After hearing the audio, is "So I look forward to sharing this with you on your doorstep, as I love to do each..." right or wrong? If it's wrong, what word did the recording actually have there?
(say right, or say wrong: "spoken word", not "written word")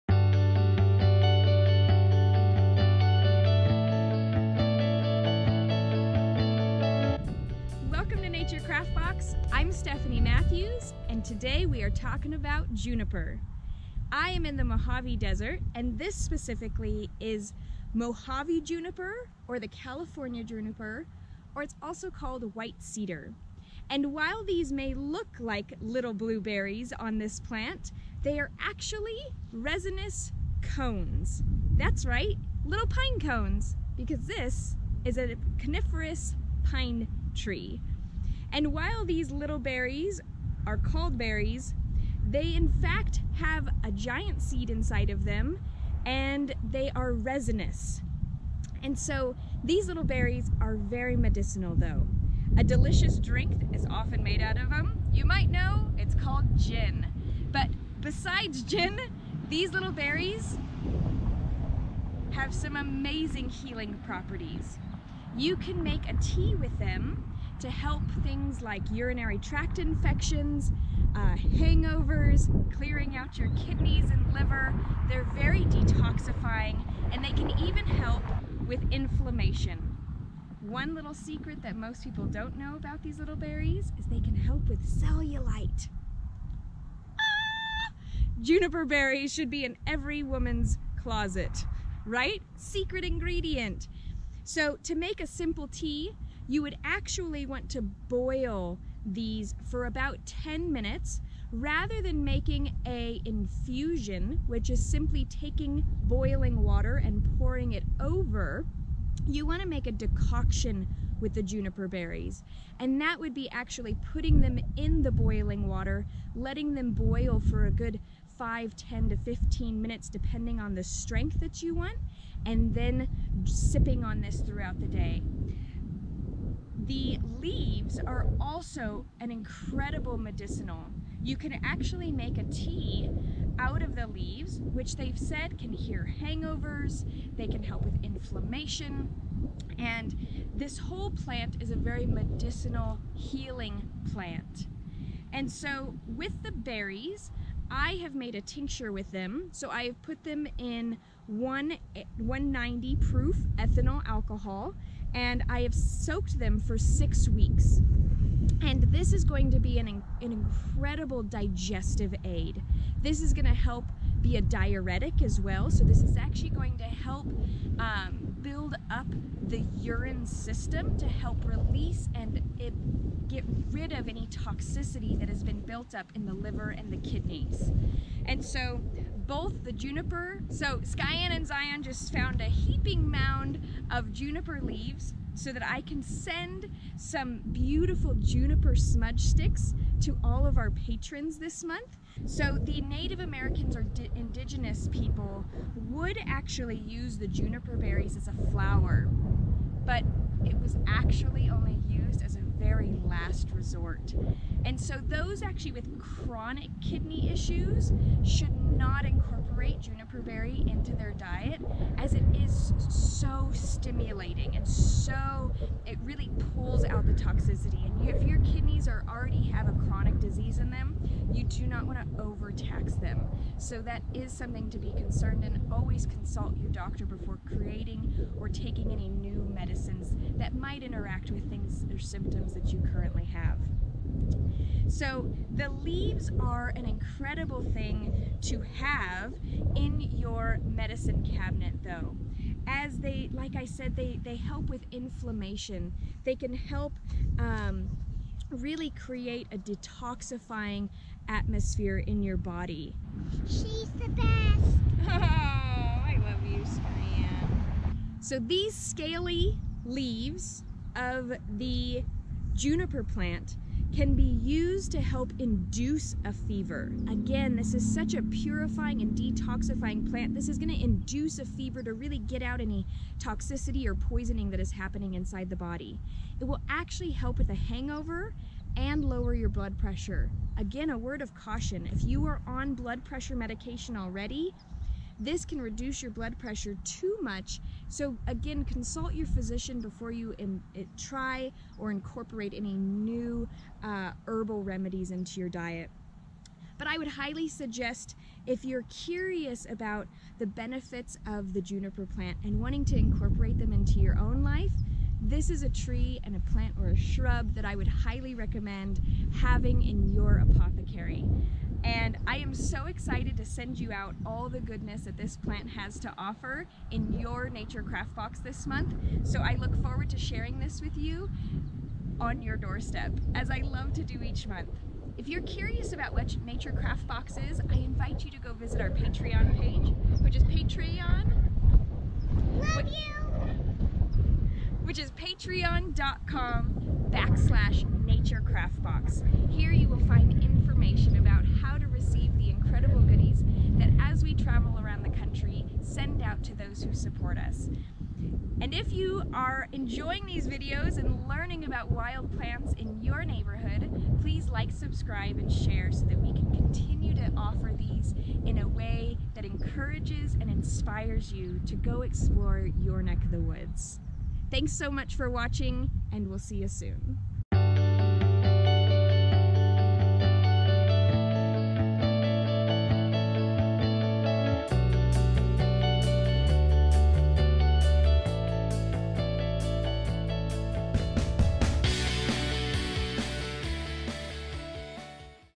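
right.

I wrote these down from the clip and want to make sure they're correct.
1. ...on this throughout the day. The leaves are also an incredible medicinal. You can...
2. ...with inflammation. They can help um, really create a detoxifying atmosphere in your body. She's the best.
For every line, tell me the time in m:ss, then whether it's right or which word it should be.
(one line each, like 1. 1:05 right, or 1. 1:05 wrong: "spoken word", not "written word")
1. 2:04 right
2. 4:04 right.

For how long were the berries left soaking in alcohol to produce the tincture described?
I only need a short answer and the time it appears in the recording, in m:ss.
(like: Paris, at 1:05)
6 weeks, at 2:36.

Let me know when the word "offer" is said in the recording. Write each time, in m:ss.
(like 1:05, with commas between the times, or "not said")
5:16, 5:57.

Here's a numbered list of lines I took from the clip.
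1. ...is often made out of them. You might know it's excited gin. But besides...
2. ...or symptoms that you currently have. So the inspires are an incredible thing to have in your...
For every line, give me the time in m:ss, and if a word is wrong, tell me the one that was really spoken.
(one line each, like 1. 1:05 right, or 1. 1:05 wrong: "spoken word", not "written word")
1. 0:53 wrong: "called", not "excited"
2. 3:51 wrong: "leaves", not "inspires".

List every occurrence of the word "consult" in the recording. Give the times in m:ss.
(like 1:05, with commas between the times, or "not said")
3:46, 4:48.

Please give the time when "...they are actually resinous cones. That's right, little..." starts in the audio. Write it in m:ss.
0:28.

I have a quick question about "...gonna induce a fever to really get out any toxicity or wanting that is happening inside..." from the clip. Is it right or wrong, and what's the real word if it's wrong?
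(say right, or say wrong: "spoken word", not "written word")
wrong: "poisoning", not "wanting".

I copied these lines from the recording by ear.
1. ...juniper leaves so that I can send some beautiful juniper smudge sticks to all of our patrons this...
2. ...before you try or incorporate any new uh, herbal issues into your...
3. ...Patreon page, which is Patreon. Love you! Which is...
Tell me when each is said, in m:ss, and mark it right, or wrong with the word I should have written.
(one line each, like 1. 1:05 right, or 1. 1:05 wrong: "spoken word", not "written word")
1. 3:04 right
2. 4:49 wrong: "remedies", not "issues"
3. 5:28 right.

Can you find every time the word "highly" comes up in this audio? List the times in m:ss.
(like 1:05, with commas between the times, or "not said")
4:57, 5:07.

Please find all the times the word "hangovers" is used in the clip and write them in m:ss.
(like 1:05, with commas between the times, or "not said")
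1:11, 2:16, 4:37.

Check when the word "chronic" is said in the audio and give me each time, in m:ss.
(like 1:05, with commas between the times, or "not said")
3:25, 3:39.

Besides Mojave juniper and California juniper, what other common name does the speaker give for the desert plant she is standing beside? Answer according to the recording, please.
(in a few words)
White cedar.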